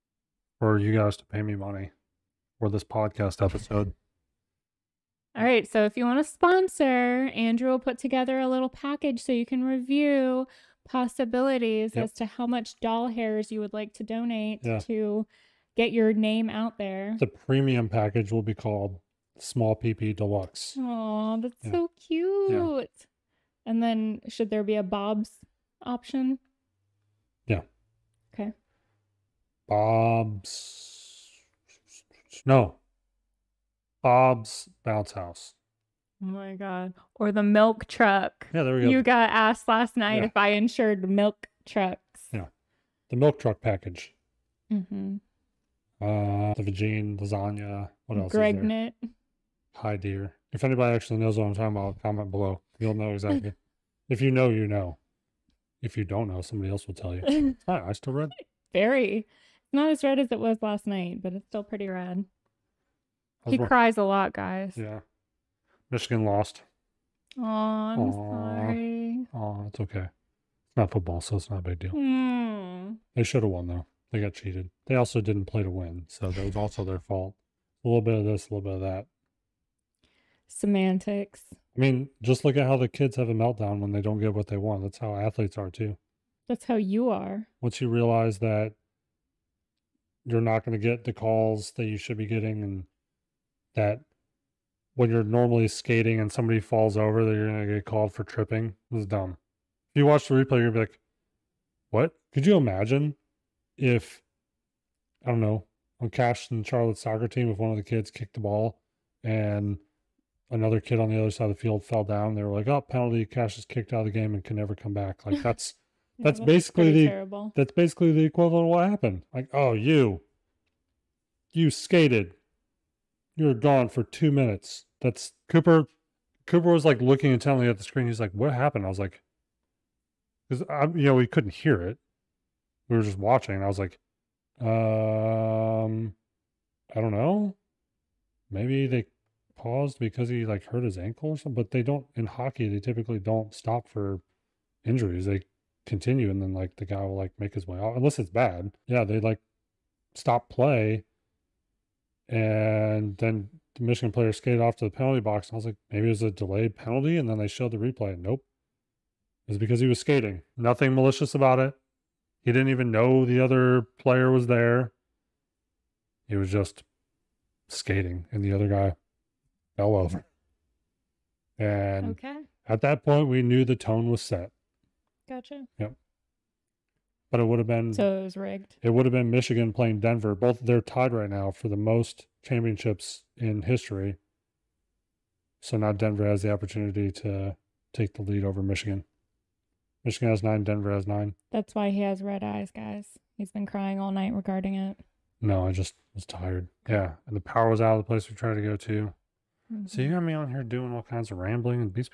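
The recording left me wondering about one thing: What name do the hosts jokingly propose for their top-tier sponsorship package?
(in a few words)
Small PP Deluxe.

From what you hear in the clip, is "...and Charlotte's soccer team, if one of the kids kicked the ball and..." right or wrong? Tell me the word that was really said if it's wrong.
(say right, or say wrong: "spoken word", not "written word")
right.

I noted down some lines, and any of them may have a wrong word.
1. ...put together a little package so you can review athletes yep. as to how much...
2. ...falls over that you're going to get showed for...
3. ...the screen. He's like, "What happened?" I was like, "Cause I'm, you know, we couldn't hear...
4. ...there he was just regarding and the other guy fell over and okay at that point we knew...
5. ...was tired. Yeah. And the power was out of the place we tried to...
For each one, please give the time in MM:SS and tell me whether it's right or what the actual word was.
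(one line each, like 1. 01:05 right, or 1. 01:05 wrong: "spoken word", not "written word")
1. 00:07 wrong: "possibilities", not "athletes"
2. 01:36 wrong: "called", not "showed"
3. 02:07 right
4. 02:44 wrong: "skating", not "regarding"
5. 03:16 right.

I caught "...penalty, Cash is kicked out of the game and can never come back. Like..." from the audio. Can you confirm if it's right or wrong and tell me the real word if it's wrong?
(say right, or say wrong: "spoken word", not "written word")
right.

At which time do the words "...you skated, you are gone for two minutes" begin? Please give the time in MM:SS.
02:01.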